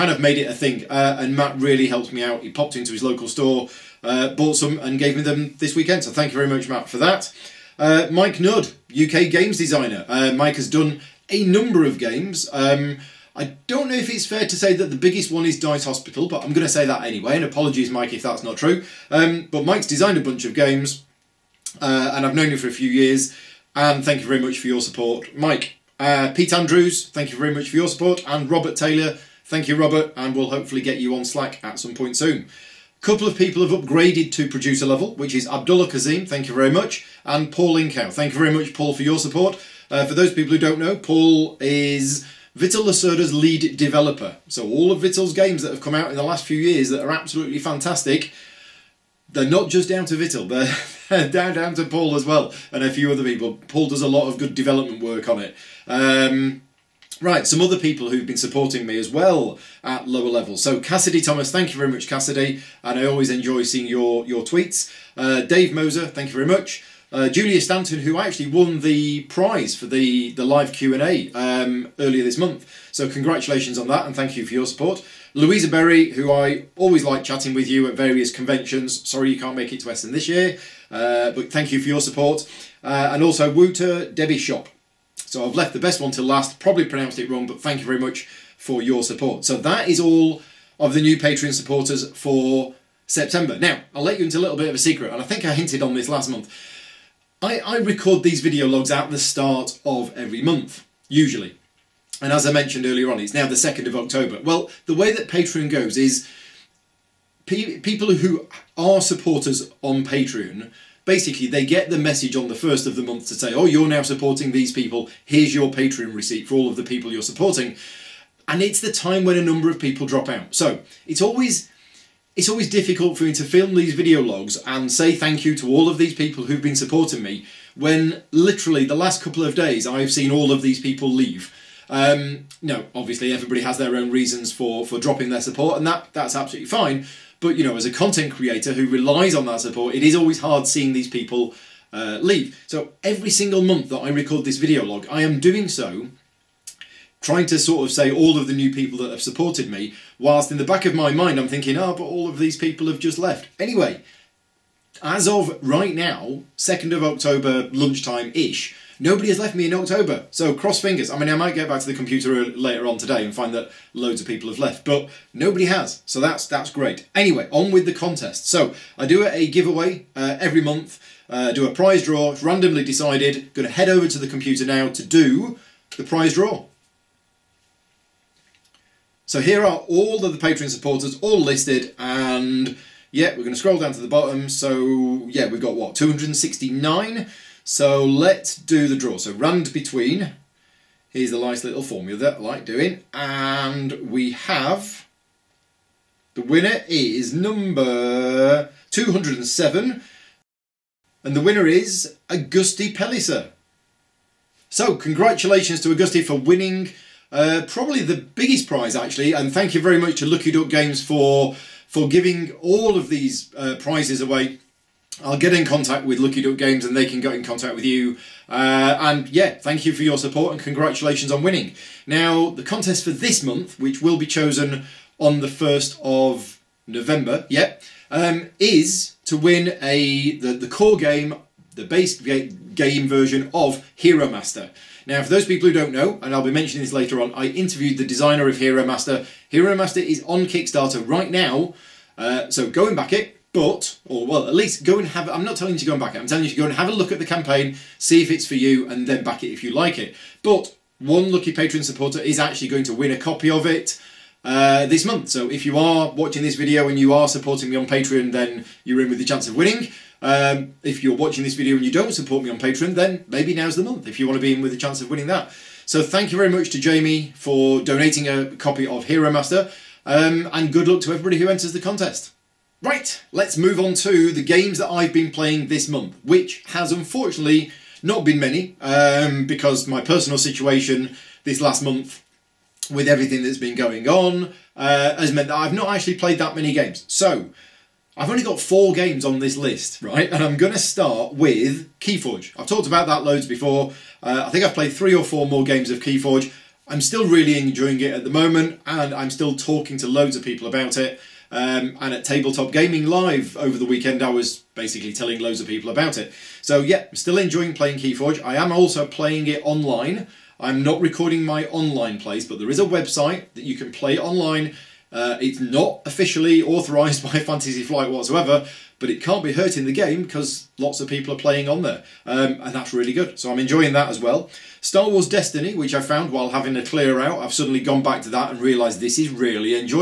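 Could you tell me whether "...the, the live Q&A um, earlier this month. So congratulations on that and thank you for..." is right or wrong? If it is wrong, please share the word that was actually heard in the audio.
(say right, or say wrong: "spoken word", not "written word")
right.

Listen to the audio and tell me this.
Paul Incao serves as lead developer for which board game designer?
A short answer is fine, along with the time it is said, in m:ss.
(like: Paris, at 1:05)
Vital Lacerda, at 0:42.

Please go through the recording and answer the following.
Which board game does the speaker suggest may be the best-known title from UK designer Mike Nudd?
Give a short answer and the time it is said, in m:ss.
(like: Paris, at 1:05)
Dice Hospital, at 0:15.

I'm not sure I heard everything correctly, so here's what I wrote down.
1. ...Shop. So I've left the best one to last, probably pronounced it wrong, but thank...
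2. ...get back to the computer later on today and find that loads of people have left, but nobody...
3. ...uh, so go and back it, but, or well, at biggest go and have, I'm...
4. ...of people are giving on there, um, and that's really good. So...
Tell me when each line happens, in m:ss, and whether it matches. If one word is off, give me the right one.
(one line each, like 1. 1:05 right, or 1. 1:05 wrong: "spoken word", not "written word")
1. 1:24 right
2. 2:41 right
3. 4:02 wrong: "least", not "biggest"
4. 5:21 wrong: "playing", not "giving".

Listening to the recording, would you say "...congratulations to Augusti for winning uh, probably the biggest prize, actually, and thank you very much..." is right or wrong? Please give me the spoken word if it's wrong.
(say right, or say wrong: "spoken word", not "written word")
right.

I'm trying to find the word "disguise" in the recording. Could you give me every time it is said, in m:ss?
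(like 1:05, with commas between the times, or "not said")
not said.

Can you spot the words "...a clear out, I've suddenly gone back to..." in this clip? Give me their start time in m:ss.
5:26.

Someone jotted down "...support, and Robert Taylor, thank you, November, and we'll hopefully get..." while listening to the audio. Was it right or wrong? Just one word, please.
wrong.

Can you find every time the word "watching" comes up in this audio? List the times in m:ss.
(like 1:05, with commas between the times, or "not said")
4:16, 4:21.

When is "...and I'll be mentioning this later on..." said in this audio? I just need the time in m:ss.
3:56.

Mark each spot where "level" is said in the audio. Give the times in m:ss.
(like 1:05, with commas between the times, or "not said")
0:34, 1:00.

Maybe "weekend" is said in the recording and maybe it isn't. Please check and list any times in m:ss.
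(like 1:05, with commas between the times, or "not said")
0:05, 5:03.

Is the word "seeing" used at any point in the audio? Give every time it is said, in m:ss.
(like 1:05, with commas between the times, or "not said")
1:03, 2:20.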